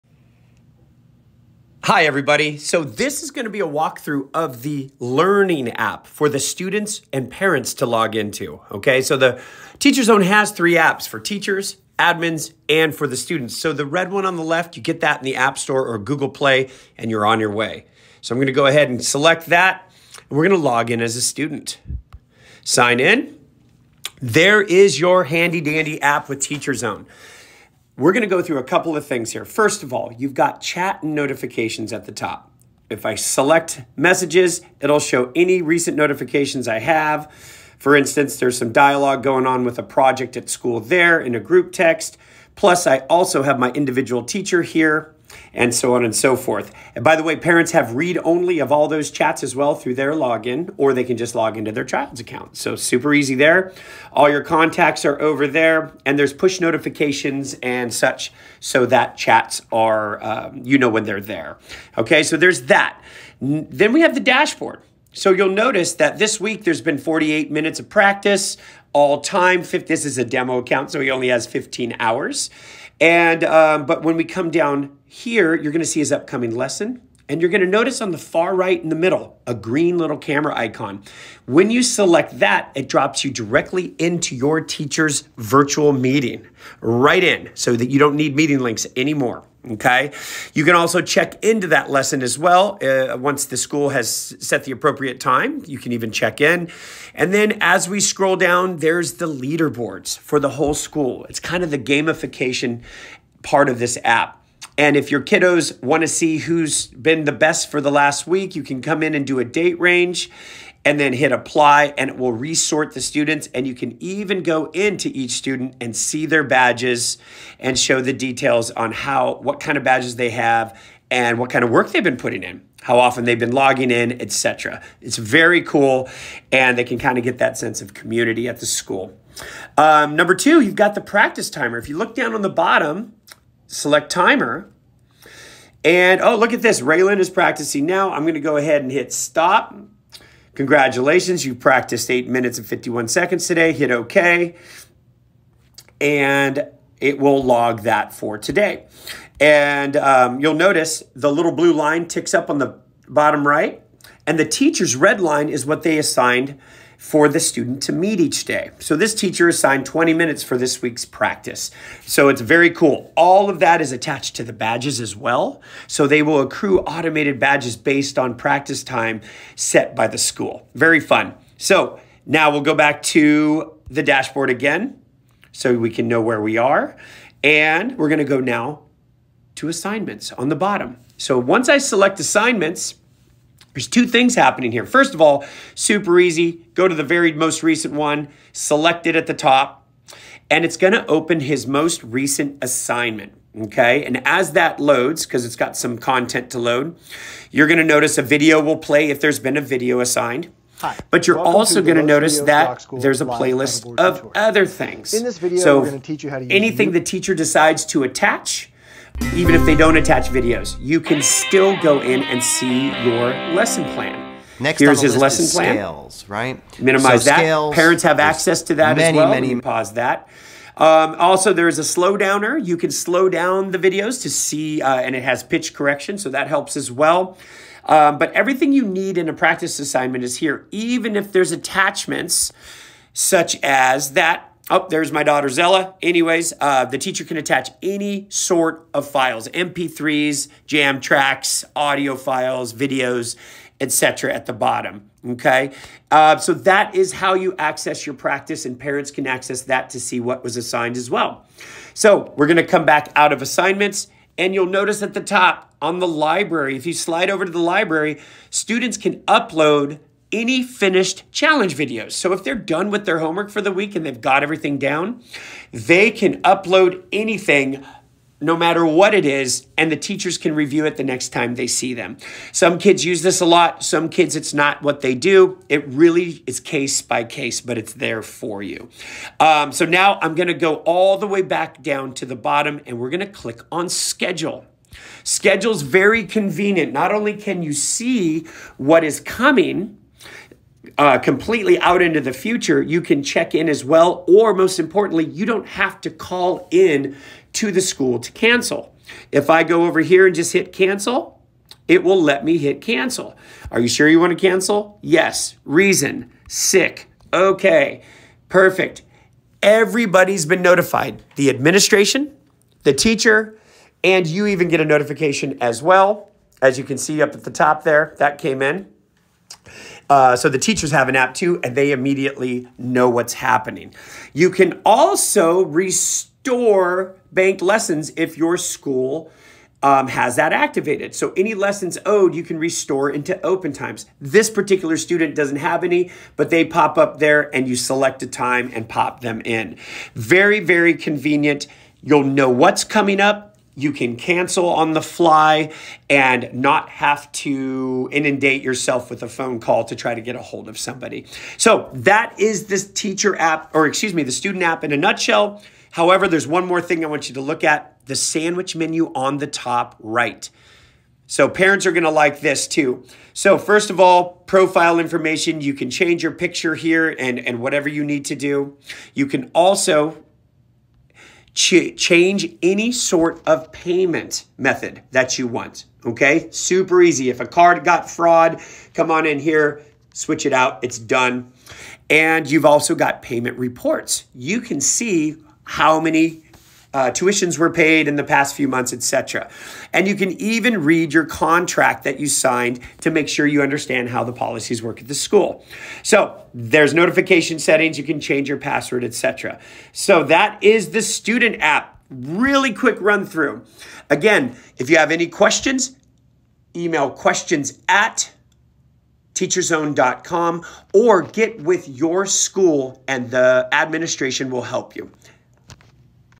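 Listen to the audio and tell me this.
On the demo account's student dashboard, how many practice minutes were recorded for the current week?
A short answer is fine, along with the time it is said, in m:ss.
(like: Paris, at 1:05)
48, at 1:06.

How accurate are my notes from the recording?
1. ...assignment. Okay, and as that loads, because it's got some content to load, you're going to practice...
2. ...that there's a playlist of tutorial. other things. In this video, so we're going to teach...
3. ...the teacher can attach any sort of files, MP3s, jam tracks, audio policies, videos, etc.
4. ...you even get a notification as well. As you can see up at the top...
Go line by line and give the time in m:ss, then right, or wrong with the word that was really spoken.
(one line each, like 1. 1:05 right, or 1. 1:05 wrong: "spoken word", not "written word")
1. 3:12 wrong: "notice", not "practice"
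2. 3:22 right
3. 3:56 wrong: "files", not "policies"
4. 5:14 right.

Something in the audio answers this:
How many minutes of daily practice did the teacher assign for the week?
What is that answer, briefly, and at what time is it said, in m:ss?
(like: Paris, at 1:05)
20, at 2:39.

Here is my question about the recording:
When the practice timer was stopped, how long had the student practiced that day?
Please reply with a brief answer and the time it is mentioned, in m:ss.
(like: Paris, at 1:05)
8 minutes 51 seconds, at 2:22.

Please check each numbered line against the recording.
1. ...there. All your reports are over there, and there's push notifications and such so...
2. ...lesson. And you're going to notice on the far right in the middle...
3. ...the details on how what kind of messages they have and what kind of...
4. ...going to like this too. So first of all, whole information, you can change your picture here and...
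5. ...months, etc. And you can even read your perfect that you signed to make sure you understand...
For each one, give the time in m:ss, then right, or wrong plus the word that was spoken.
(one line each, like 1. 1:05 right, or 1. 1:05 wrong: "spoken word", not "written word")
1. 0:53 wrong: "contacts", not "reports"
2. 1:16 right
3. 1:58 wrong: "badges", not "messages"
4. 6:01 wrong: "profile", not "whole"
5. 6:28 wrong: "contract", not "perfect".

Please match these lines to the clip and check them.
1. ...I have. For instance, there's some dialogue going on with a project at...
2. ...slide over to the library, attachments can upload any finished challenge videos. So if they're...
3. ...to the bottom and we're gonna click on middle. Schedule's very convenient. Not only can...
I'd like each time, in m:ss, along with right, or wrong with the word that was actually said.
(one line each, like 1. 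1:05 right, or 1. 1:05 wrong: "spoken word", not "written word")
1. 0:36 right
2. 4:16 wrong: "students", not "attachments"
3. 4:42 wrong: "schedule", not "middle".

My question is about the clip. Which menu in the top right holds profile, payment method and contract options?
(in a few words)
Sandwich menu.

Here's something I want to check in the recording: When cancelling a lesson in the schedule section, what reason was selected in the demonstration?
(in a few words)
Sick.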